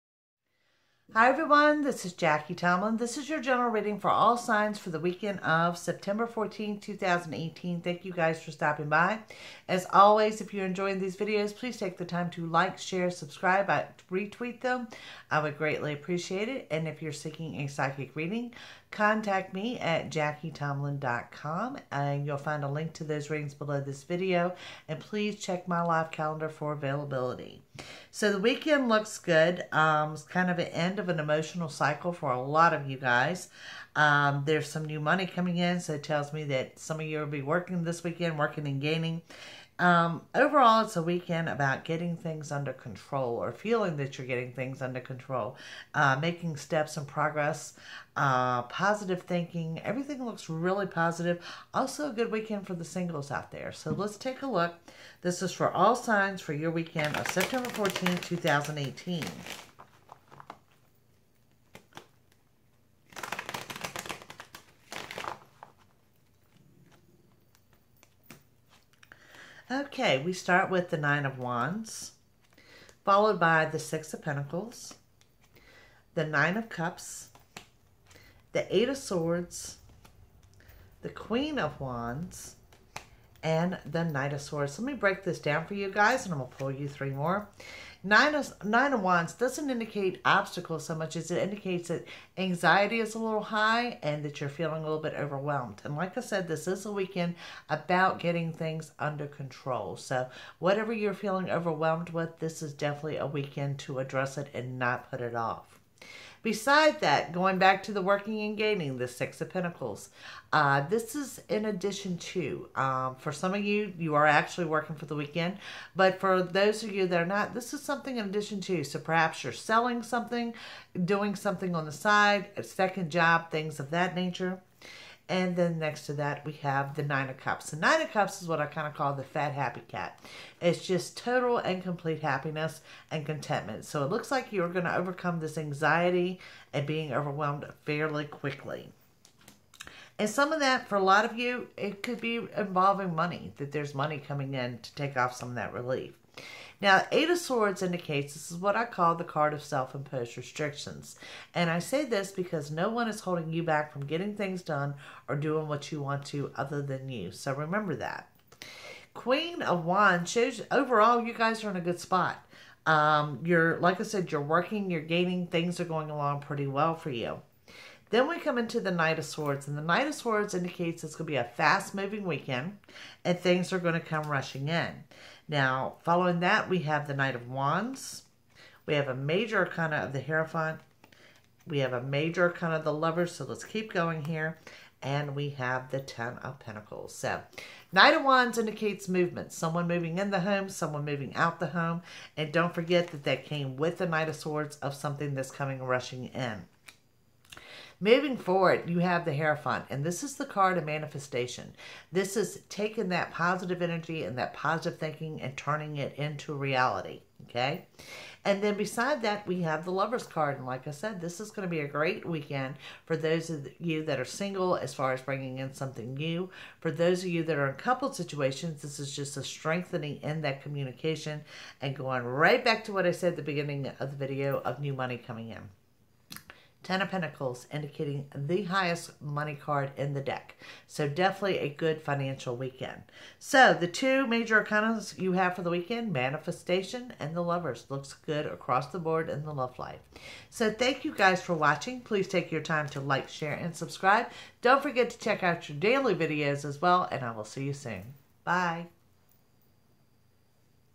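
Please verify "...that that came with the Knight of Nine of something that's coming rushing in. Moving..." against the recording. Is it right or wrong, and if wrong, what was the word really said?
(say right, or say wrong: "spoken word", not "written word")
wrong: "Swords", not "Nine".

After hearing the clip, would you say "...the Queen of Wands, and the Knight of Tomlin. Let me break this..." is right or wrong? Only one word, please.
wrong.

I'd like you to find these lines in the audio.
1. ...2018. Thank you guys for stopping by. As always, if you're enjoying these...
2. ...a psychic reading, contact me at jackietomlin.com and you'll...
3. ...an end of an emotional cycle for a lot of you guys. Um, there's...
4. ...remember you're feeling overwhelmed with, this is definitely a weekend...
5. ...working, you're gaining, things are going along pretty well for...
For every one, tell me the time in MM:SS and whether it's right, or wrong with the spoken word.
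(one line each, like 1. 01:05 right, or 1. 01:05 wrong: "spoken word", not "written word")
1. 00:06 right
2. 00:17 right
3. 00:30 right
4. 01:40 wrong: "whatever", not "remember"
5. 02:44 right.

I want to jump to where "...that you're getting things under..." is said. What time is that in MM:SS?
00:43.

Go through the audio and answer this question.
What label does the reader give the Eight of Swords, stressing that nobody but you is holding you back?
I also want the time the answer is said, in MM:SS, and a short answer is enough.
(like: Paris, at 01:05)
Self imposed restrictions, at 02:29.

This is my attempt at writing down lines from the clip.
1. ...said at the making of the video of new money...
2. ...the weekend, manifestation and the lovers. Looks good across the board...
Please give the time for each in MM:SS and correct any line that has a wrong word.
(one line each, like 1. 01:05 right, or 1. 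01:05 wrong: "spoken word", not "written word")
1. 03:43 wrong: "beginning", not "making"
2. 03:55 right.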